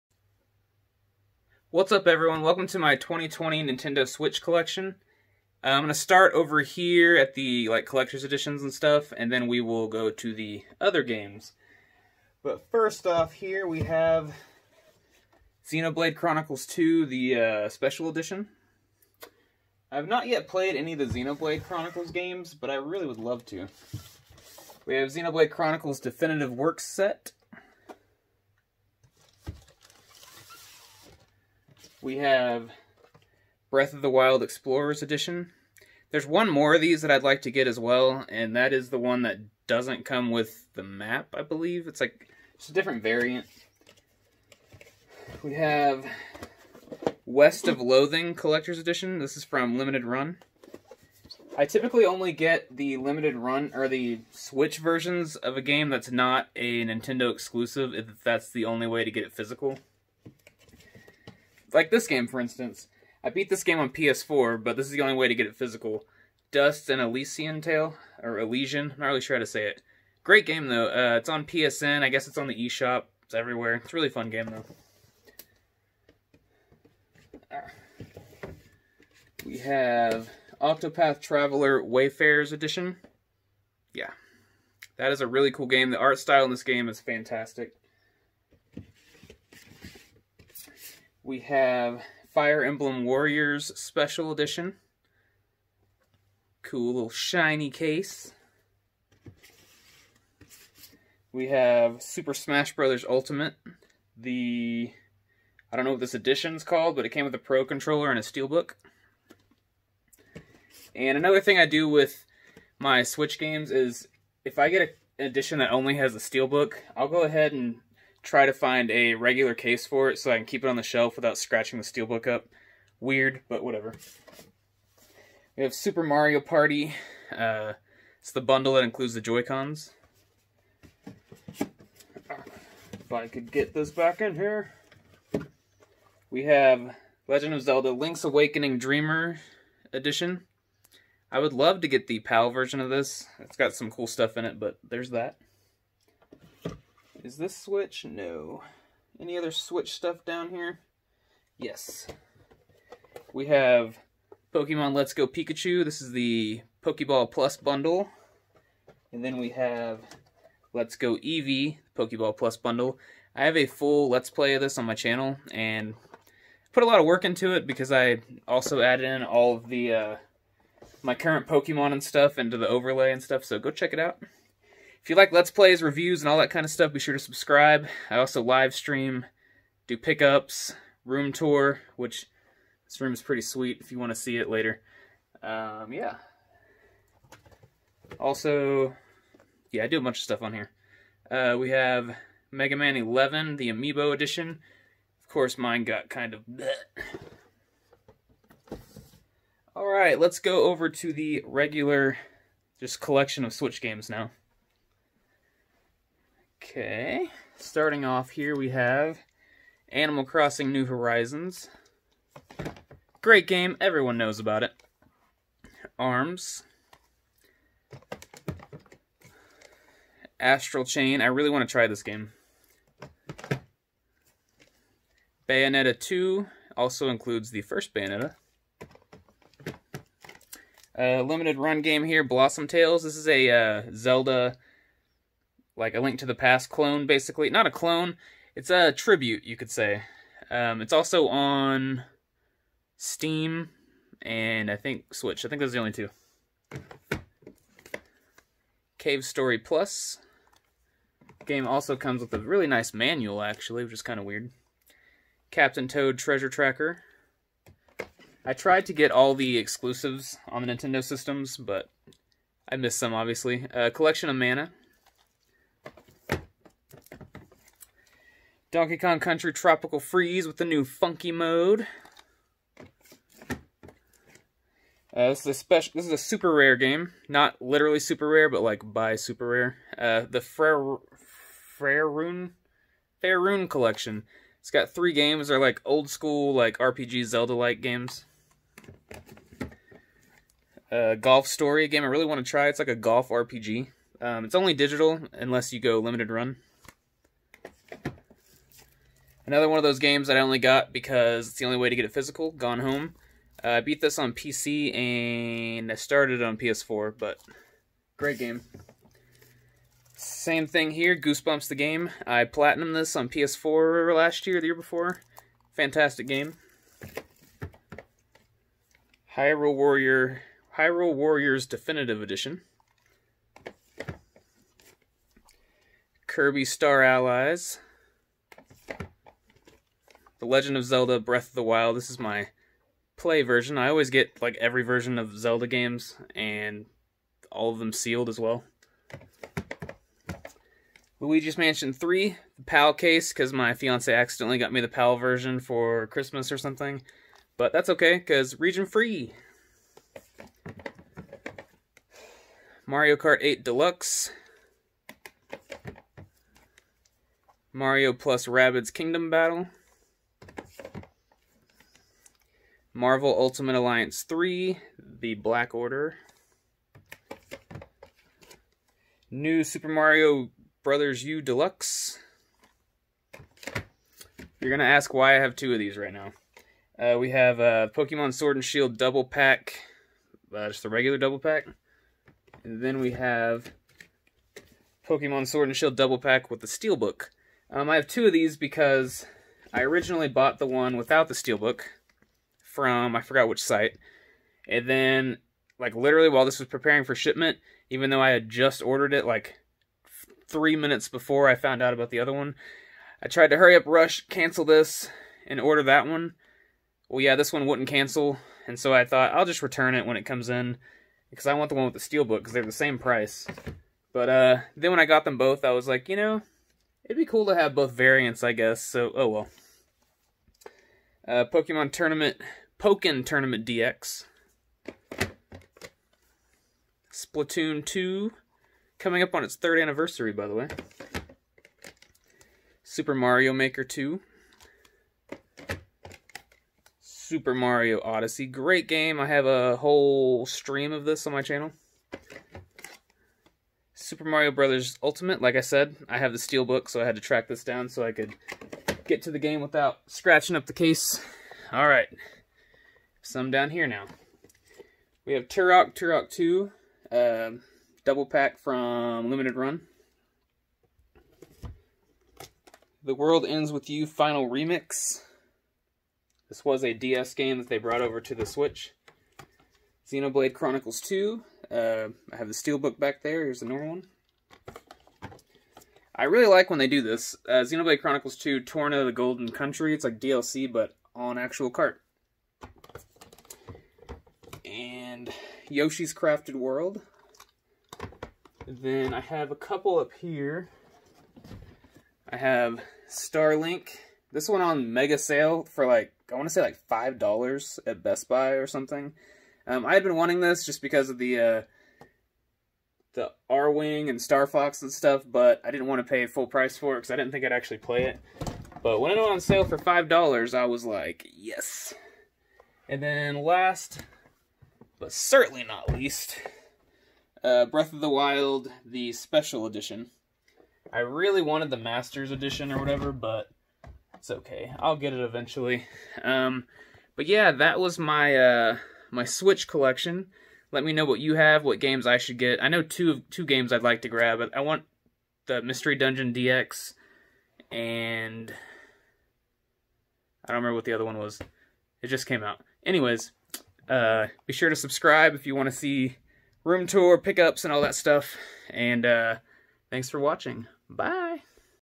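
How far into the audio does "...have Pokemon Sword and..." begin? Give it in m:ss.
6:23.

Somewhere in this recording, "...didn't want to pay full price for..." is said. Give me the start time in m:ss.
8:25.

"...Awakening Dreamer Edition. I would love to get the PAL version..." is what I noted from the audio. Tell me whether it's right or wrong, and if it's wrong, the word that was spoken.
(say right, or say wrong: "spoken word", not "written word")
right.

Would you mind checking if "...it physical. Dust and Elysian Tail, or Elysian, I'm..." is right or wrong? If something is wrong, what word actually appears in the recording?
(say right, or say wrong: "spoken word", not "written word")
right.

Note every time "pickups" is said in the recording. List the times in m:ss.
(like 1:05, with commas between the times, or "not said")
2:59, 9:07.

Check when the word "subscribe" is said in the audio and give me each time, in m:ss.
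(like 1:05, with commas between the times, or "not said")
2:57, 9:04.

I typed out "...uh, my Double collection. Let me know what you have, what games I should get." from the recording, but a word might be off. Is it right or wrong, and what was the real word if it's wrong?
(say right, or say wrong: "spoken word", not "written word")
wrong: "Switch", not "Double".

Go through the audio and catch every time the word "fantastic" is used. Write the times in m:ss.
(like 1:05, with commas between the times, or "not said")
1:26, 5:15.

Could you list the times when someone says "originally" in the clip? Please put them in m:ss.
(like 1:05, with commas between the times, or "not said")
6:29.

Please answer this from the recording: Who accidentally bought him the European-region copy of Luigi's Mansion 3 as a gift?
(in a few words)
My fiance.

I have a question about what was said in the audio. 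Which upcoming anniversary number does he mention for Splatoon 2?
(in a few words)
Third.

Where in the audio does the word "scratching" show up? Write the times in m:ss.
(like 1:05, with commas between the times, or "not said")
2:01, 7:30.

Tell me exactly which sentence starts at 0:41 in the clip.
It's like, it's a different variant.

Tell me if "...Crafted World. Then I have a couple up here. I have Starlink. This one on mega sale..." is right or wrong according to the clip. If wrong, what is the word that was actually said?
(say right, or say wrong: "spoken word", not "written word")
right.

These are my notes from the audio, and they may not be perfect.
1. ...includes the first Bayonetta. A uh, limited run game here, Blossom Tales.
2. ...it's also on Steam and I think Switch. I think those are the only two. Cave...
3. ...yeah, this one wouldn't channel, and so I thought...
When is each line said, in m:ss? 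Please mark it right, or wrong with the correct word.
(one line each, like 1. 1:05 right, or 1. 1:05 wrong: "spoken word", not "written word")
1. 3:47 right
2. 4:00 right
3. 6:47 wrong: "cancel", not "channel".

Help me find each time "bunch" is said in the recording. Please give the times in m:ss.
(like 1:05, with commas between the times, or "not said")
3:10.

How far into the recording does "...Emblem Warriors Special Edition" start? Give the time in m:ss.
1:32.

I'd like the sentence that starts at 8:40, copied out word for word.
I really wanted the Masters edition or whatever, but it's okay.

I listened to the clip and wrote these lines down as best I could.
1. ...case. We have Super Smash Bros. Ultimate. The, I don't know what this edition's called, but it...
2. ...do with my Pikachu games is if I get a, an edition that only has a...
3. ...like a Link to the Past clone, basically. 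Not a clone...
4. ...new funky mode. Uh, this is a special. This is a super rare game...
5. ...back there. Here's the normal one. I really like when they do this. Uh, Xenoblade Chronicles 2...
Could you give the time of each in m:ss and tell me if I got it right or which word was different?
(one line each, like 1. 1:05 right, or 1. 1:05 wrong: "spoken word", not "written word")
1. 1:37 right
2. 1:51 wrong: "Switch", not "Pikachu"
3. 3:55 right
4. 4:30 right
5. 7:52 right.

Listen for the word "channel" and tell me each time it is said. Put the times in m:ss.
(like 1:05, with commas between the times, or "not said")
2:44, 7:21.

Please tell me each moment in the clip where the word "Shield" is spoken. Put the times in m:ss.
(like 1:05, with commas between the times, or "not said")
6:18, 6:25.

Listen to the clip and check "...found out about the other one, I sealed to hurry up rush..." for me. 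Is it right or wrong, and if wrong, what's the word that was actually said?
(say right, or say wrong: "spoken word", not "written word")
wrong: "tried", not "sealed".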